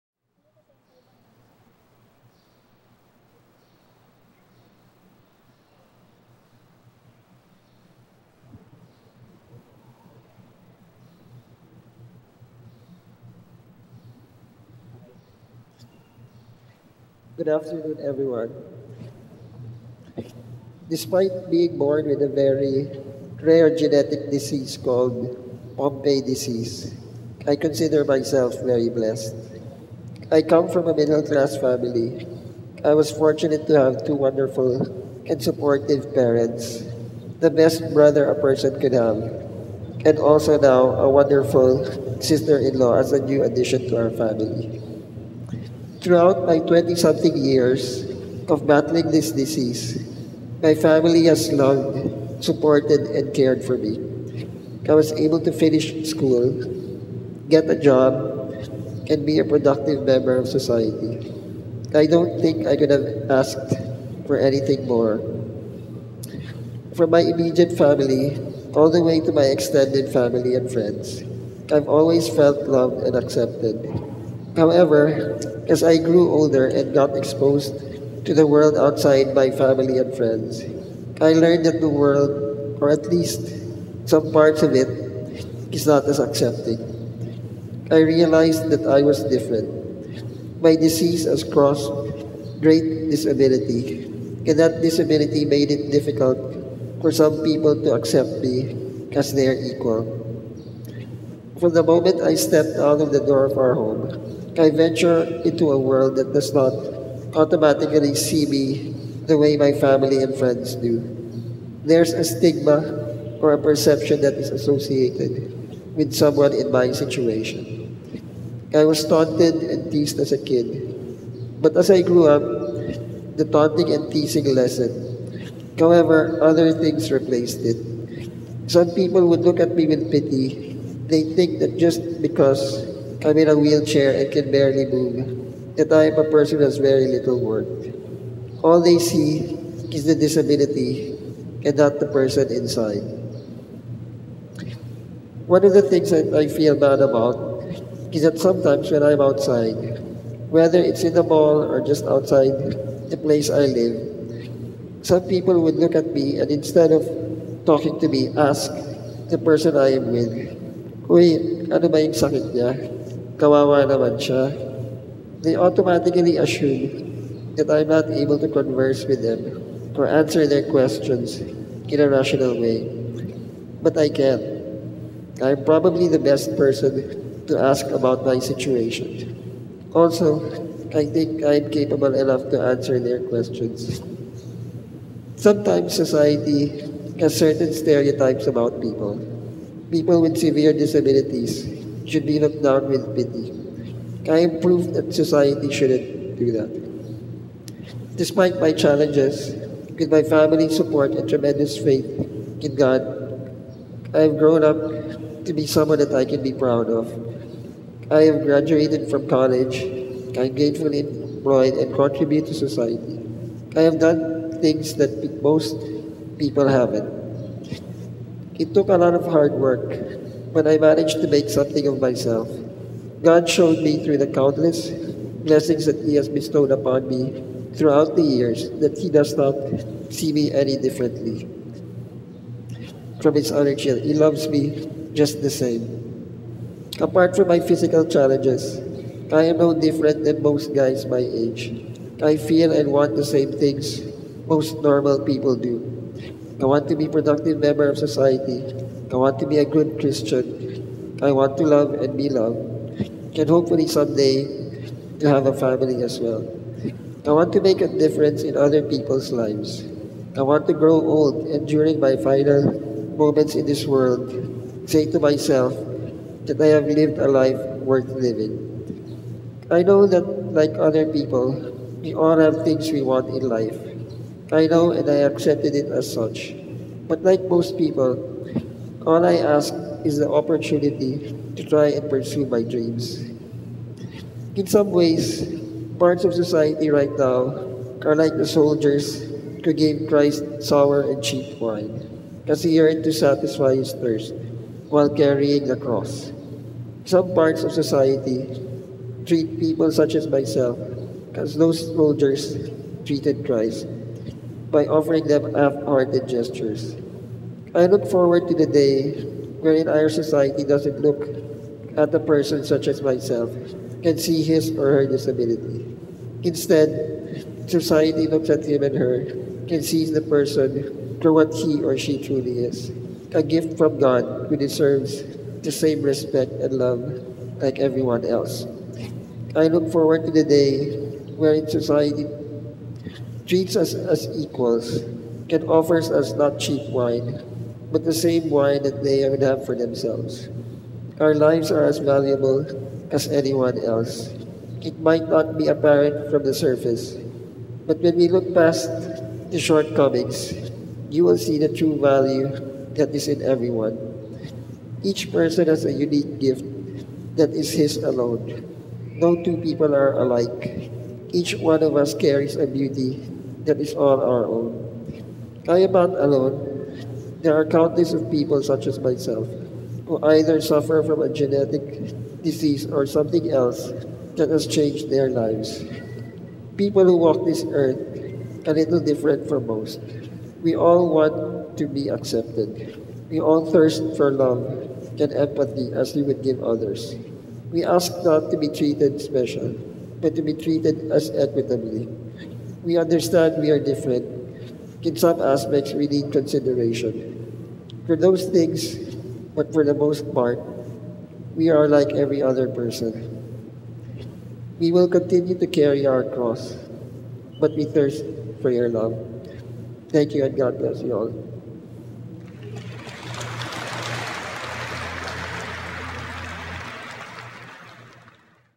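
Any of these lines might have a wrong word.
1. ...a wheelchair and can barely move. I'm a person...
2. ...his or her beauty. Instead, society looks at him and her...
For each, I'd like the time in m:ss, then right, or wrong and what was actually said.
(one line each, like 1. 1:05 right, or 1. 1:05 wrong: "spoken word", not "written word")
1. 2:13 right
2. 5:14 wrong: "disability", not "beauty".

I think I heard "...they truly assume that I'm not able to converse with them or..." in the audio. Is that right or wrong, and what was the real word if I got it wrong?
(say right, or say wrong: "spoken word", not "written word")
wrong: "automatically", not "truly".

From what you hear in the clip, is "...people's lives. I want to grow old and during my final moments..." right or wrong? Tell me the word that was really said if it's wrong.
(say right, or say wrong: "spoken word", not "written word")
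right.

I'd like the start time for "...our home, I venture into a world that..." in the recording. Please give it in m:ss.
1:43.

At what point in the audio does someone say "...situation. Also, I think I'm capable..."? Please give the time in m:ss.
2:58.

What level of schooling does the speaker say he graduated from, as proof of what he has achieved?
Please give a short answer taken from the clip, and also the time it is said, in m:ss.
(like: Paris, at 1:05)
college, at 3:29.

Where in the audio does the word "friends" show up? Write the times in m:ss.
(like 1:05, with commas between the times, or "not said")
1:10, 1:20, 1:50.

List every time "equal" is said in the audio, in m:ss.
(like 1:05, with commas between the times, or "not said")
1:39, 5:34.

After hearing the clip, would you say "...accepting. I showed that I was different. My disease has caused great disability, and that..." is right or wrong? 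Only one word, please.
wrong.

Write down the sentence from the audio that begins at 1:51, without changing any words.
There's a stigma or a perception that is associated with someone in my situation.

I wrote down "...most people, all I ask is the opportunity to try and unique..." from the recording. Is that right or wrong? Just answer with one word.
wrong.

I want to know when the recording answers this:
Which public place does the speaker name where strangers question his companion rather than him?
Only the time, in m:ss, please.
2:31.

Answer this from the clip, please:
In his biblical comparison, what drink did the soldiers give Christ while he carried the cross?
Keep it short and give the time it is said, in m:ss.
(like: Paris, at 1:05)
sour and cheap wine, at 4:50.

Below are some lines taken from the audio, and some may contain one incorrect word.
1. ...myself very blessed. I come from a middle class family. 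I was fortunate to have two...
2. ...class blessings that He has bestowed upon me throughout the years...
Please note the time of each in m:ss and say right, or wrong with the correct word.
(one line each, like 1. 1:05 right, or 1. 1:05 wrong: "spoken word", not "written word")
1. 0:28 right
2. 3:44 wrong: "countless", not "class".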